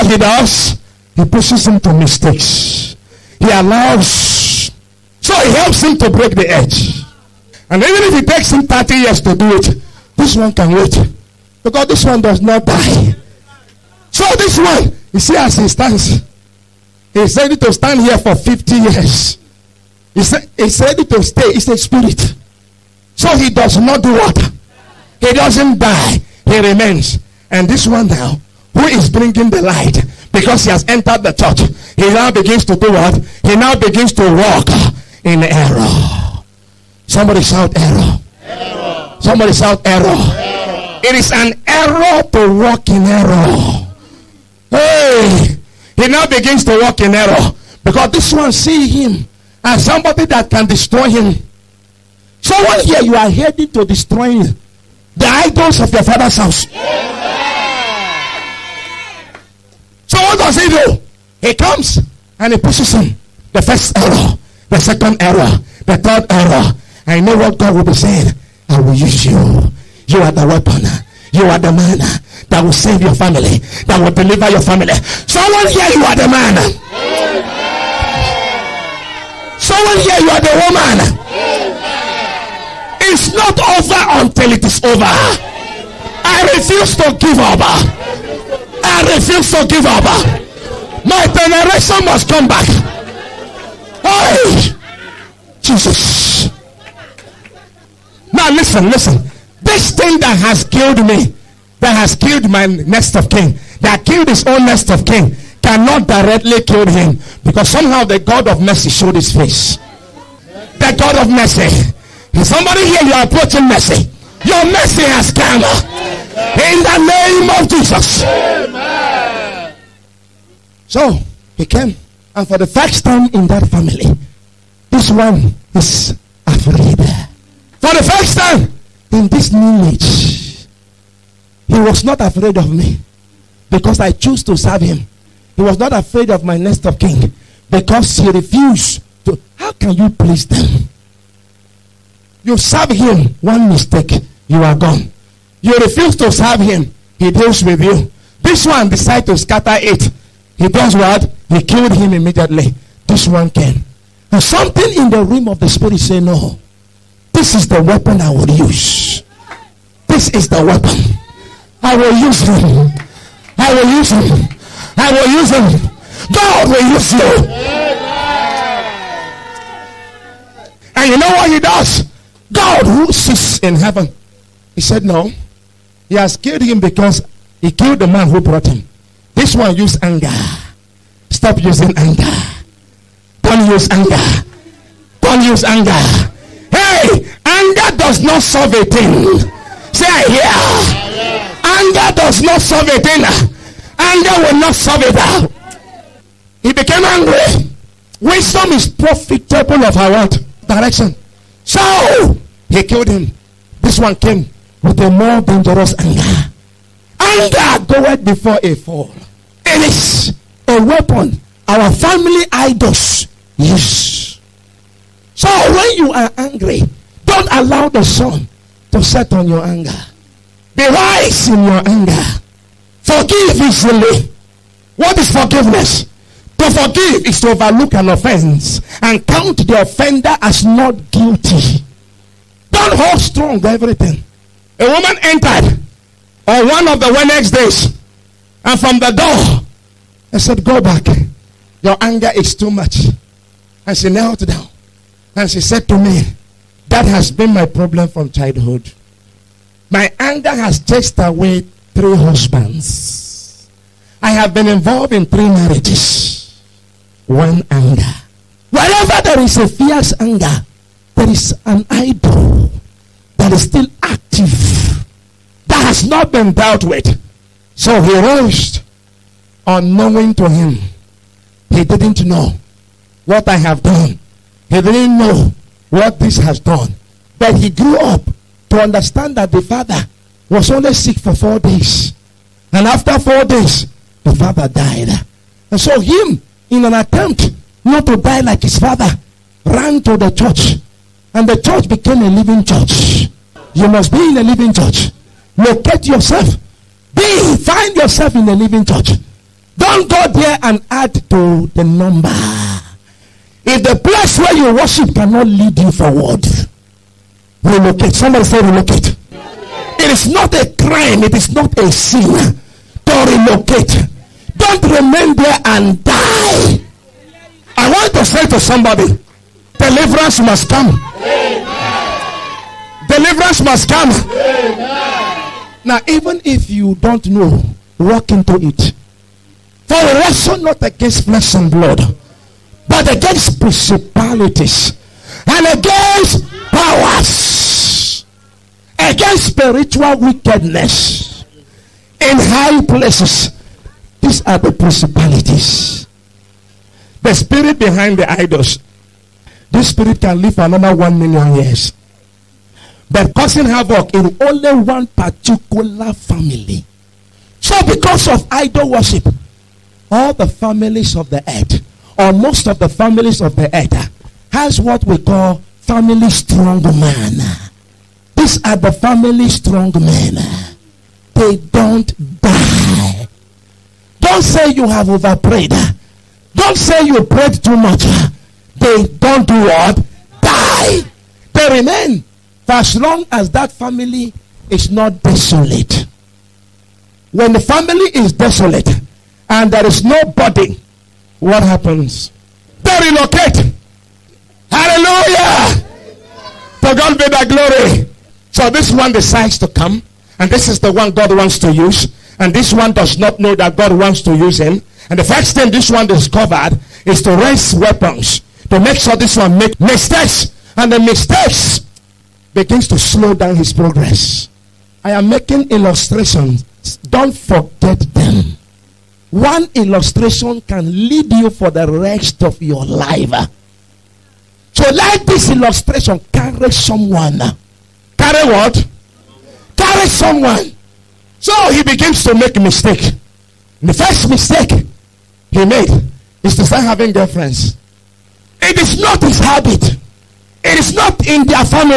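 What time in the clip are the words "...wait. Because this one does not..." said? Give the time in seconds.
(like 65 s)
10 s.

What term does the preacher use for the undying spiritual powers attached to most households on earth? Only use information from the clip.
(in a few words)
family strong man.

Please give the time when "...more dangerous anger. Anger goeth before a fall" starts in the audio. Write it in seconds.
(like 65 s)
205 s.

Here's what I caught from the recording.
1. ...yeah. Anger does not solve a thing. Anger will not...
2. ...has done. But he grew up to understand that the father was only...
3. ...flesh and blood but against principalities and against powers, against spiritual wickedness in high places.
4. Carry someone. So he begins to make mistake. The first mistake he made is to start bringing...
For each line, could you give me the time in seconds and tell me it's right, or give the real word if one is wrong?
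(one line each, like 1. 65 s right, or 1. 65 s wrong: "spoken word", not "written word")
1. 190 s right
2. 276 s right
3. 331 s right
4. 429 s wrong: "having", not "bringing".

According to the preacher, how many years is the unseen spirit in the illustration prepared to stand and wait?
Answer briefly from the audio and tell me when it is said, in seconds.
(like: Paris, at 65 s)
50 years, at 18 s.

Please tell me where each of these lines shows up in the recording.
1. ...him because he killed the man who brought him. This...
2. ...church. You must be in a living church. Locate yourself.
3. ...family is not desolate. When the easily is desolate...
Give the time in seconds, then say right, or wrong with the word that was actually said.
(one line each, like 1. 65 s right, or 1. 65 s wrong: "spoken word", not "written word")
1. 176 s right
2. 292 s right
3. 383 s wrong: "family", not "easily".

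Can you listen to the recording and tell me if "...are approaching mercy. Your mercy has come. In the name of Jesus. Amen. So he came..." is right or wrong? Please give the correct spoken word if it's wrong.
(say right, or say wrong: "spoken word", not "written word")
right.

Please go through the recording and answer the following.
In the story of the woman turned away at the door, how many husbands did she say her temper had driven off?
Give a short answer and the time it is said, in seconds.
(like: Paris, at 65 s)
3, at 251 s.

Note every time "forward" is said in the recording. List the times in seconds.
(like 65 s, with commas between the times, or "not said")
305 s.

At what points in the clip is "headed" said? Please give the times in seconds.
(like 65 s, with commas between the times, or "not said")
53 s.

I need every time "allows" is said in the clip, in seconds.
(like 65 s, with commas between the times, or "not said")
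3 s, 217 s.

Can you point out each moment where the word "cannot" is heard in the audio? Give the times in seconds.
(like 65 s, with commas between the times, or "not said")
105 s, 305 s.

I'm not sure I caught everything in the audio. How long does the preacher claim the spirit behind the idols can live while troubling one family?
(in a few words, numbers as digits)
1 million years.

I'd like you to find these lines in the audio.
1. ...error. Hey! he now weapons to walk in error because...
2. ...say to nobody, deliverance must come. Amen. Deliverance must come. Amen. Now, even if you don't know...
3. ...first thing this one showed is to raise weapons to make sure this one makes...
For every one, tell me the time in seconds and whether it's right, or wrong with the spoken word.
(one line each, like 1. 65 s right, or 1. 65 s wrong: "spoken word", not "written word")
1. 43 s wrong: "begins", not "weapons"
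2. 318 s wrong: "somebody", not "nobody"
3. 405 s wrong: "discovered", not "showed".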